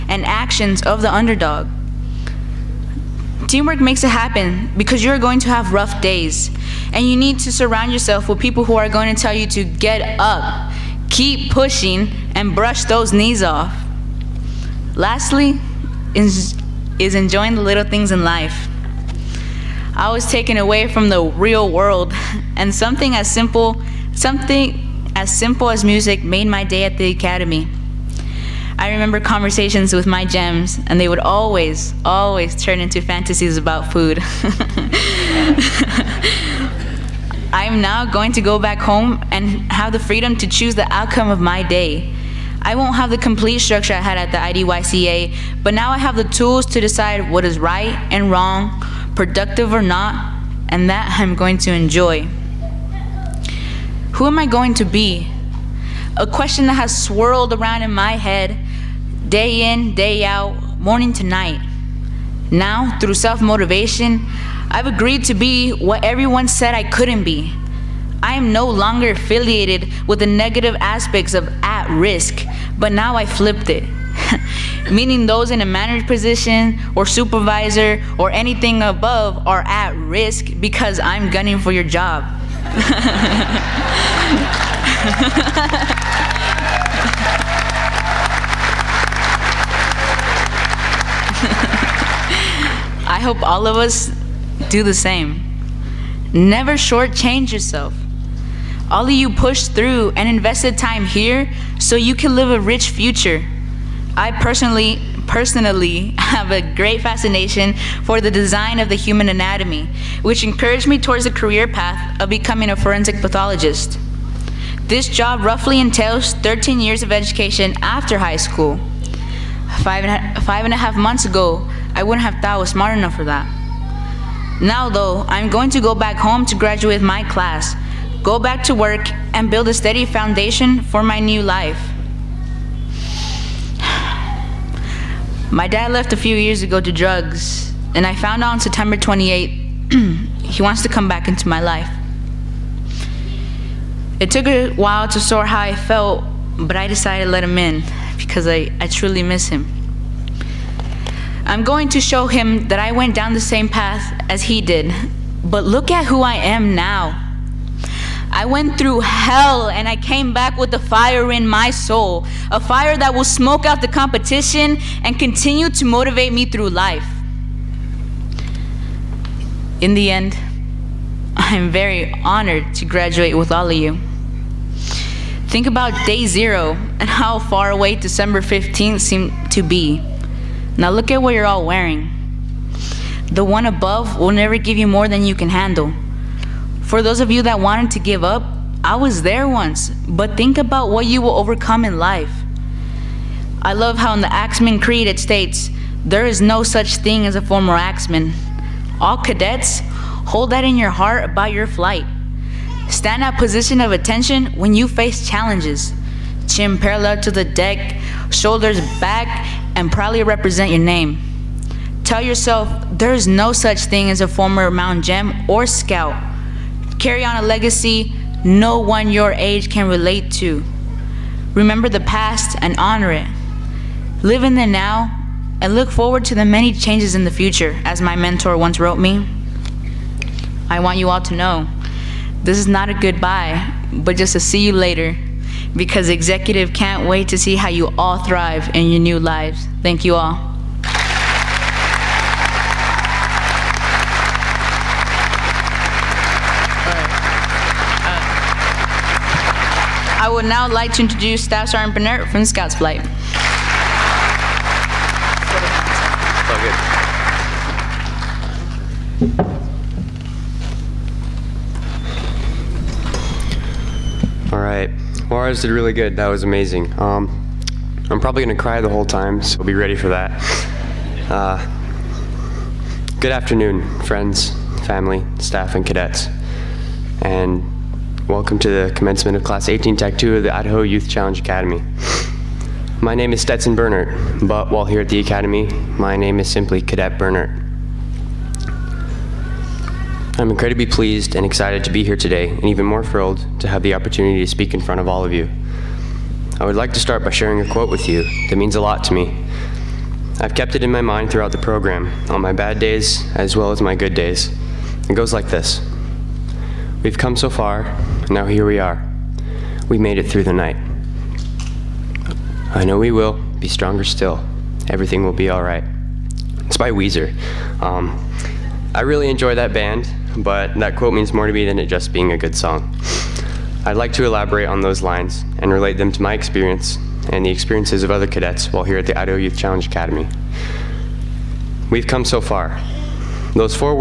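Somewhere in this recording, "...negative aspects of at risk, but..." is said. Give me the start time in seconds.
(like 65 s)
70 s.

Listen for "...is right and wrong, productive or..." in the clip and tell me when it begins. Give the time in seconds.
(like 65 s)
47 s.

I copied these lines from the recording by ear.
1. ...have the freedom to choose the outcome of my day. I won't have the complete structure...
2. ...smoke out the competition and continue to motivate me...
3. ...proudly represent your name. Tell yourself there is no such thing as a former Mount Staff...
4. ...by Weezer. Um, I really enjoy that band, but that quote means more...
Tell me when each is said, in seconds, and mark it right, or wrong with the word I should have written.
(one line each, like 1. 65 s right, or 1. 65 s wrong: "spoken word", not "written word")
1. 39 s right
2. 163 s right
3. 209 s wrong: "Gem", not "Staff"
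4. 316 s right.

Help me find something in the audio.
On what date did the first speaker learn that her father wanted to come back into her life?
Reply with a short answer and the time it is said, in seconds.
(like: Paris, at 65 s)
September 28th, at 138 s.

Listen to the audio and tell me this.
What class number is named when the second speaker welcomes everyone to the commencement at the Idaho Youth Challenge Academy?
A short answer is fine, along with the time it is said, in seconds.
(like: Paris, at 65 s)
Class 18, at 279 s.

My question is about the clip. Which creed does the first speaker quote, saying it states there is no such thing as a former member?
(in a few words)
Axeman Creed.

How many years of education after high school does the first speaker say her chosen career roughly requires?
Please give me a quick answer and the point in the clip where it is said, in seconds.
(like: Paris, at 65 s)
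13, at 116 s.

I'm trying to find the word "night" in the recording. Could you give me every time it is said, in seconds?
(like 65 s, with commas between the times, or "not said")
61 s, 310 s.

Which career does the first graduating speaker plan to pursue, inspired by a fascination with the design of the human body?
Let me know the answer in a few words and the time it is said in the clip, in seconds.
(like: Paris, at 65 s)
forensic pathologist, at 112 s.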